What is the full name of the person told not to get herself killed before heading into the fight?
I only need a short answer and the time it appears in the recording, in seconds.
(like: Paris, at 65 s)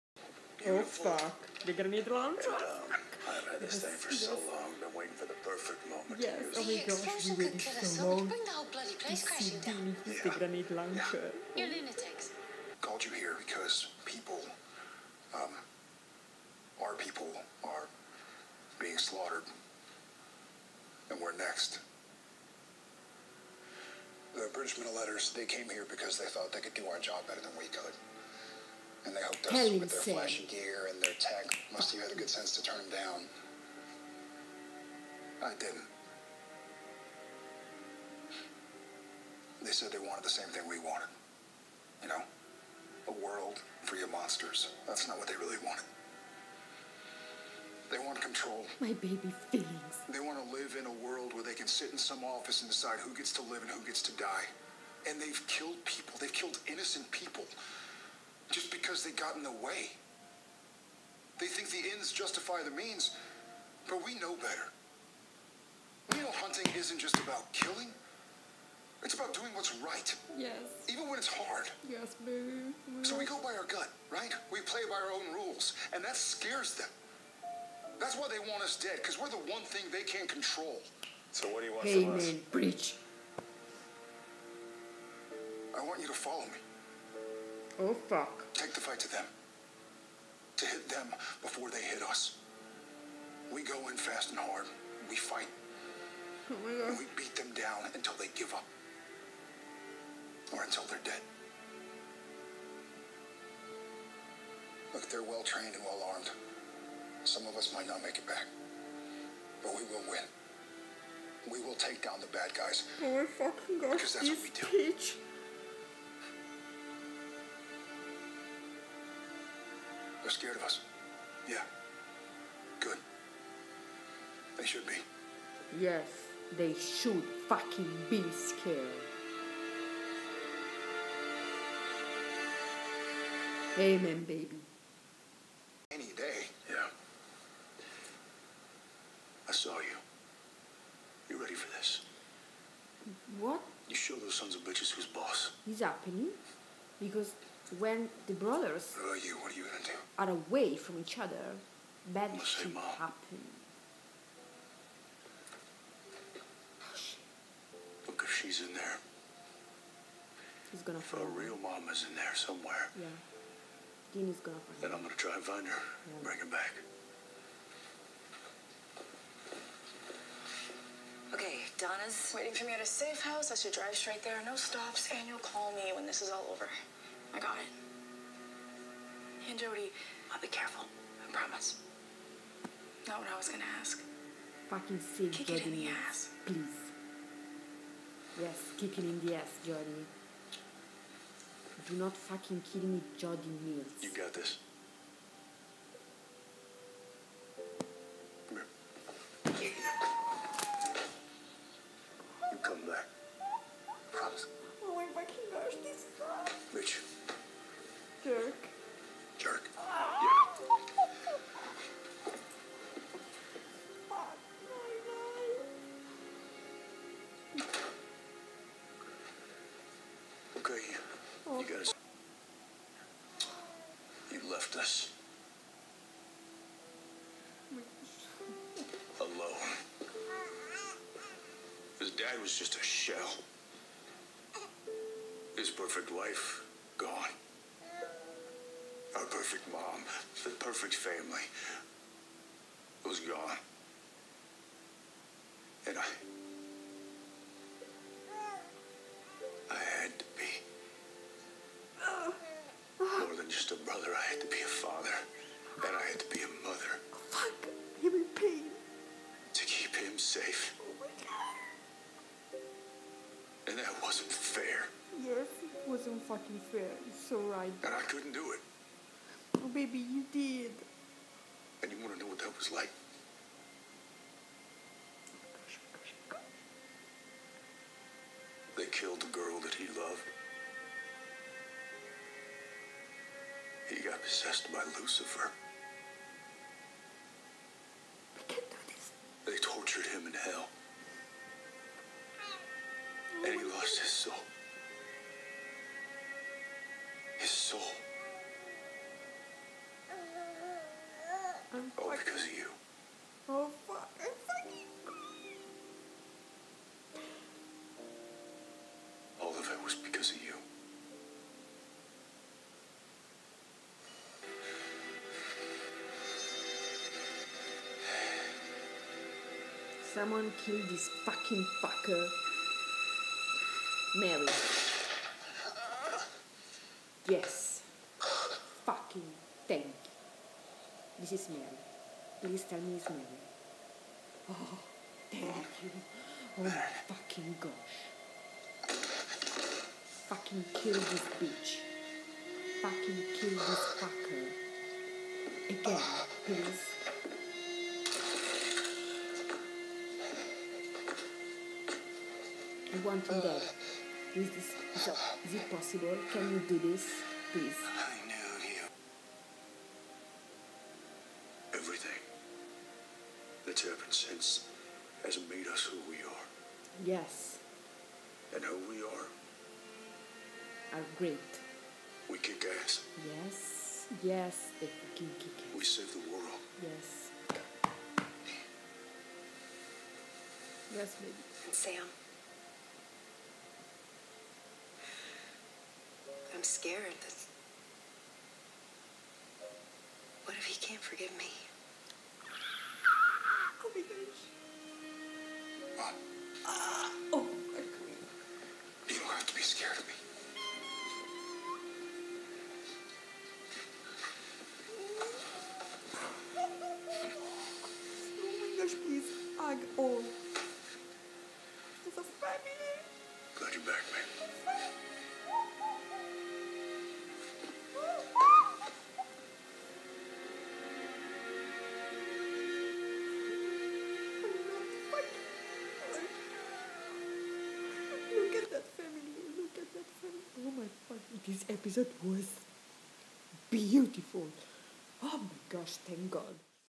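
Jody Mills, at 193 s.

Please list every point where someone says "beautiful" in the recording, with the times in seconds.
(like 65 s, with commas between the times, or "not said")
0 s, 433 s.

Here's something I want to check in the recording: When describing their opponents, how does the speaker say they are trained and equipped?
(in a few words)
Well trained and well armed.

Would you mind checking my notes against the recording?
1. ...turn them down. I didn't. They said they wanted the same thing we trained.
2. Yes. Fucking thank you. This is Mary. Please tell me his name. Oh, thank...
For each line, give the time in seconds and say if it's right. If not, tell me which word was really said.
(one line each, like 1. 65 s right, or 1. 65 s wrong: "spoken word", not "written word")
1. 32 s wrong: "wanted", not "trained"
2. 327 s right.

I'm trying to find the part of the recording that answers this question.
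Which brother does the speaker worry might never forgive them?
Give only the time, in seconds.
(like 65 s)
381 s.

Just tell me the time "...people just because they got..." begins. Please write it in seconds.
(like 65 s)
57 s.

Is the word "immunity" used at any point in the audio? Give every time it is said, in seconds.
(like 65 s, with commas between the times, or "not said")
not said.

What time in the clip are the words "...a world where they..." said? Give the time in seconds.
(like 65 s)
50 s.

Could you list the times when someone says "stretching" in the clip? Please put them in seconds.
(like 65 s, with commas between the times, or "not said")
not said.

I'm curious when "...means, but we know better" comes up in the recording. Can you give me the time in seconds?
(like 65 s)
62 s.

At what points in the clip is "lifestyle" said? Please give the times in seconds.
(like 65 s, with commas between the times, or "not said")
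not said.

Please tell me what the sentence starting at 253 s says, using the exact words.
More than just a brother, I had to be a father.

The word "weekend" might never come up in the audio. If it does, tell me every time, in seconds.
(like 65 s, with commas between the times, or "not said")
not said.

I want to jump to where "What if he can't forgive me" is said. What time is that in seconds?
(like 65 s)
390 s.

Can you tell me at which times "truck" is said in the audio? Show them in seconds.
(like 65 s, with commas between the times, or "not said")
2 s.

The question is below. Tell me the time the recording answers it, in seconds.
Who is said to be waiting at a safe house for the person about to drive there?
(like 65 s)
171 s.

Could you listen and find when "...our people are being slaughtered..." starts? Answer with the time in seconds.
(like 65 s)
16 s.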